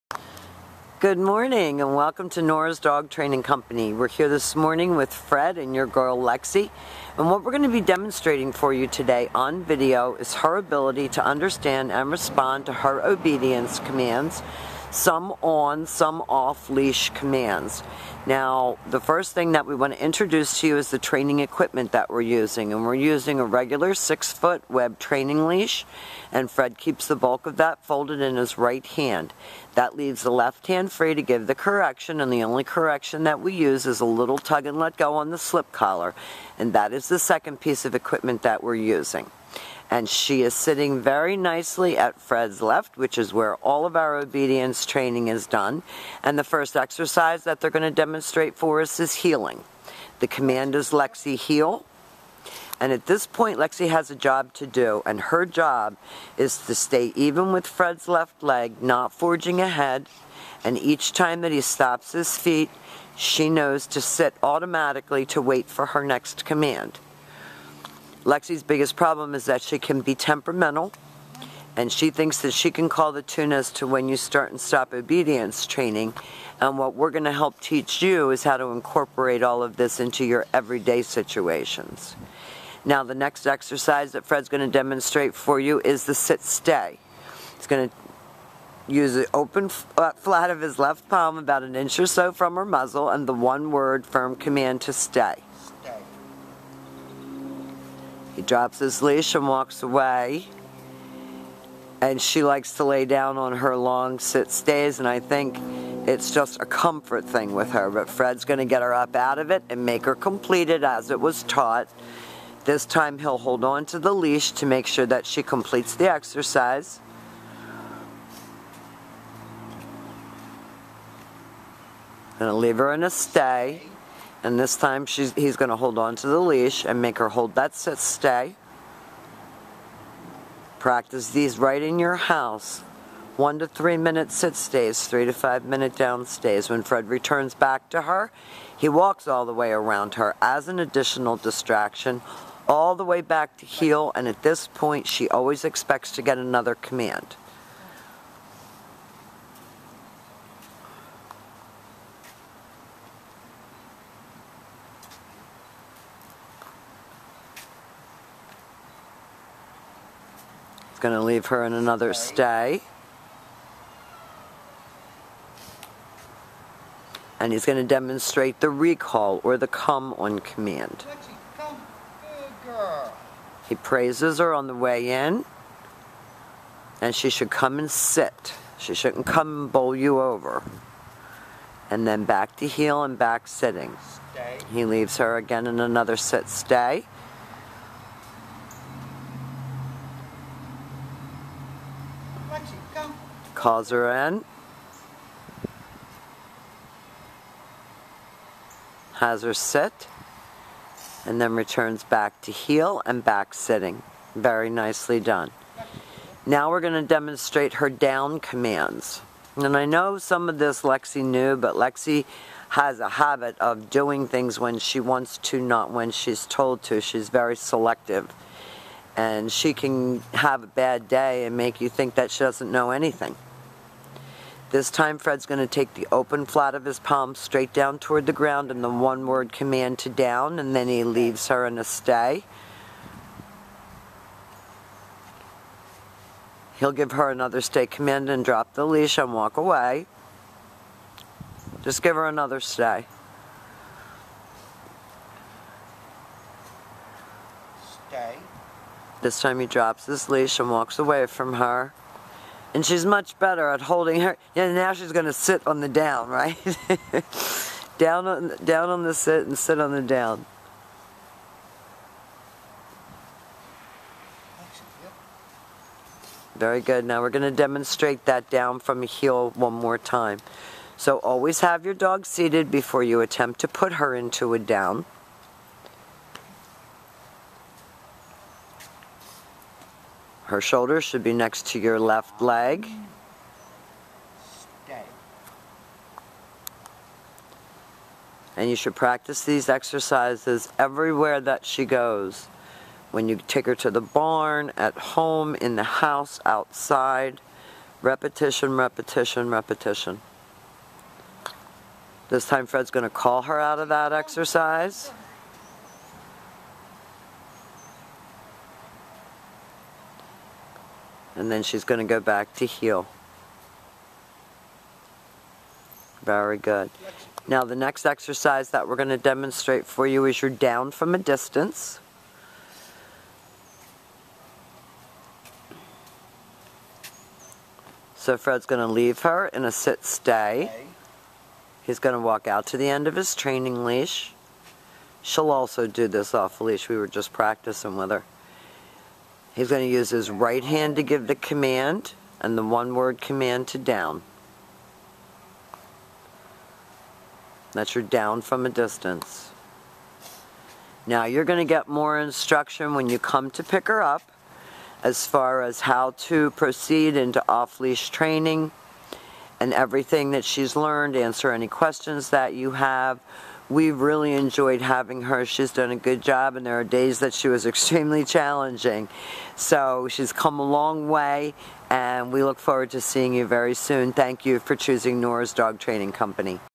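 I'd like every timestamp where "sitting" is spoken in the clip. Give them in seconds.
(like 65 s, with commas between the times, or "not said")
40 s, 183 s, 203 s.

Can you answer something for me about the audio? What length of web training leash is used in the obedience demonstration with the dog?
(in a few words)
6 feet.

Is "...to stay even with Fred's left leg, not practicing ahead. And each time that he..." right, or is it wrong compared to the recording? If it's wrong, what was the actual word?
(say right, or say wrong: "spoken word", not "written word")
wrong: "forging", not "practicing".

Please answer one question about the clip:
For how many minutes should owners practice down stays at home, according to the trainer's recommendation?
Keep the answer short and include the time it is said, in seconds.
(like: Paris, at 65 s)
3 to 5 minutes, at 135 s.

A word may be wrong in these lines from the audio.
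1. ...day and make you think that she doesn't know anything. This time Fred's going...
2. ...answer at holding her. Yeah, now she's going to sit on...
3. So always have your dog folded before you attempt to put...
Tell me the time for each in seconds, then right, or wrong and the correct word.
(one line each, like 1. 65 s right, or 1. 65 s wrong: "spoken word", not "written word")
1. 221 s right
2. 253 s wrong: "better", not "answer"
3. 270 s wrong: "seated", not "folded".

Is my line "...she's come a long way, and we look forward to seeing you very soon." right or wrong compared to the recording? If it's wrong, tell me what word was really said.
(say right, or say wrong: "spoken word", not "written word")
right.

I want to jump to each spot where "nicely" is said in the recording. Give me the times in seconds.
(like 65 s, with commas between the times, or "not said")
41 s, 204 s.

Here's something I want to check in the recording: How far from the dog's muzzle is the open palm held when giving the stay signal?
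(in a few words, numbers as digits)
an inch.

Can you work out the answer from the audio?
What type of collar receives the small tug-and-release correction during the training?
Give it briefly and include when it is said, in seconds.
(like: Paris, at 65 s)
slip collar, at 35 s.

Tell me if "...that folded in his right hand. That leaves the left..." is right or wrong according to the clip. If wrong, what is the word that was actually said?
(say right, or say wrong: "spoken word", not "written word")
right.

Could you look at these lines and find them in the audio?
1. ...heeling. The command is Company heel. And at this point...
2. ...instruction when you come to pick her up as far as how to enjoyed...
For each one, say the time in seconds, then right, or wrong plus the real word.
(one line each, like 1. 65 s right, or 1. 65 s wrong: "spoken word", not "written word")
1. 49 s wrong: "Lexy", not "Company"
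2. 352 s wrong: "proceed", not "enjoyed".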